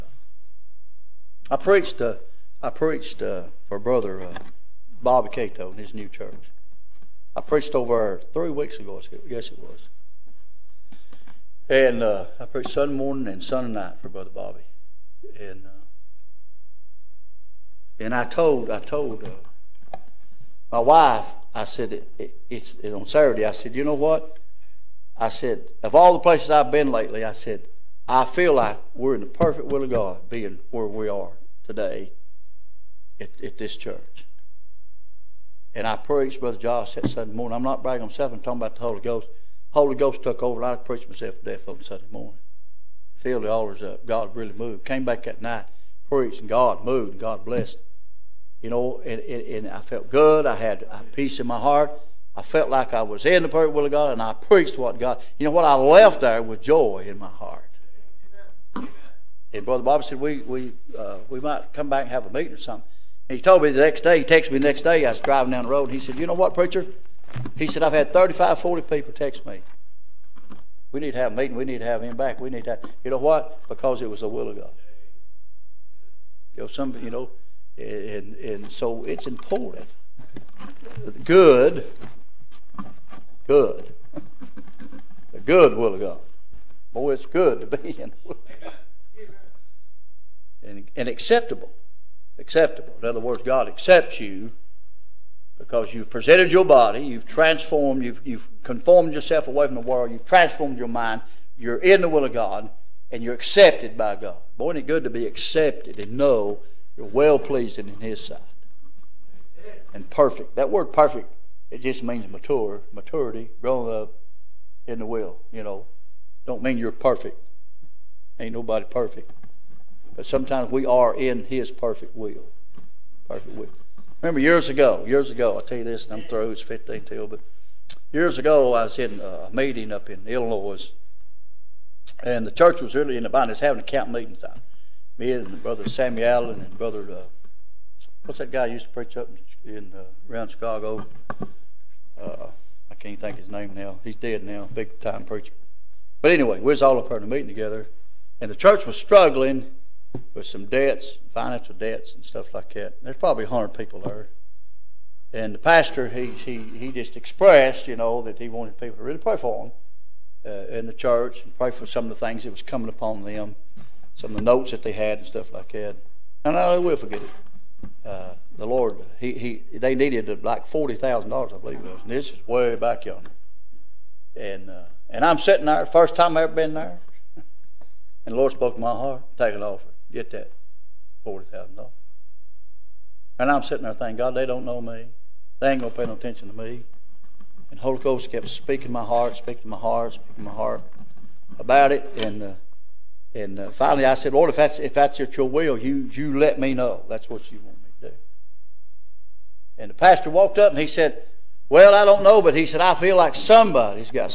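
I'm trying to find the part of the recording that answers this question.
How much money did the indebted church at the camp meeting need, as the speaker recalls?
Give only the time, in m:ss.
2:50.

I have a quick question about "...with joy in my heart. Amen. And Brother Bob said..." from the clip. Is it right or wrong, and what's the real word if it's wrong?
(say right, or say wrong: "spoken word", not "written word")
right.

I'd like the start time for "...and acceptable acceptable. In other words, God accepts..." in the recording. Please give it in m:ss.
1:30.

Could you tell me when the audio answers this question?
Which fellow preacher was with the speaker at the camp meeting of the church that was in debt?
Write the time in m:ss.
2:15.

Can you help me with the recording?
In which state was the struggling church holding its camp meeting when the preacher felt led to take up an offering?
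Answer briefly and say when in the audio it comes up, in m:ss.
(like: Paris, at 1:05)
Illinois, at 2:10.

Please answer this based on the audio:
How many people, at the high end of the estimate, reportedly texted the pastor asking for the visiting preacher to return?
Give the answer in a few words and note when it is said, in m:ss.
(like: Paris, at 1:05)
40, at 1:08.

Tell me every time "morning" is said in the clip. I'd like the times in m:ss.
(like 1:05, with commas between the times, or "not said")
0:12, 0:37, 0:42.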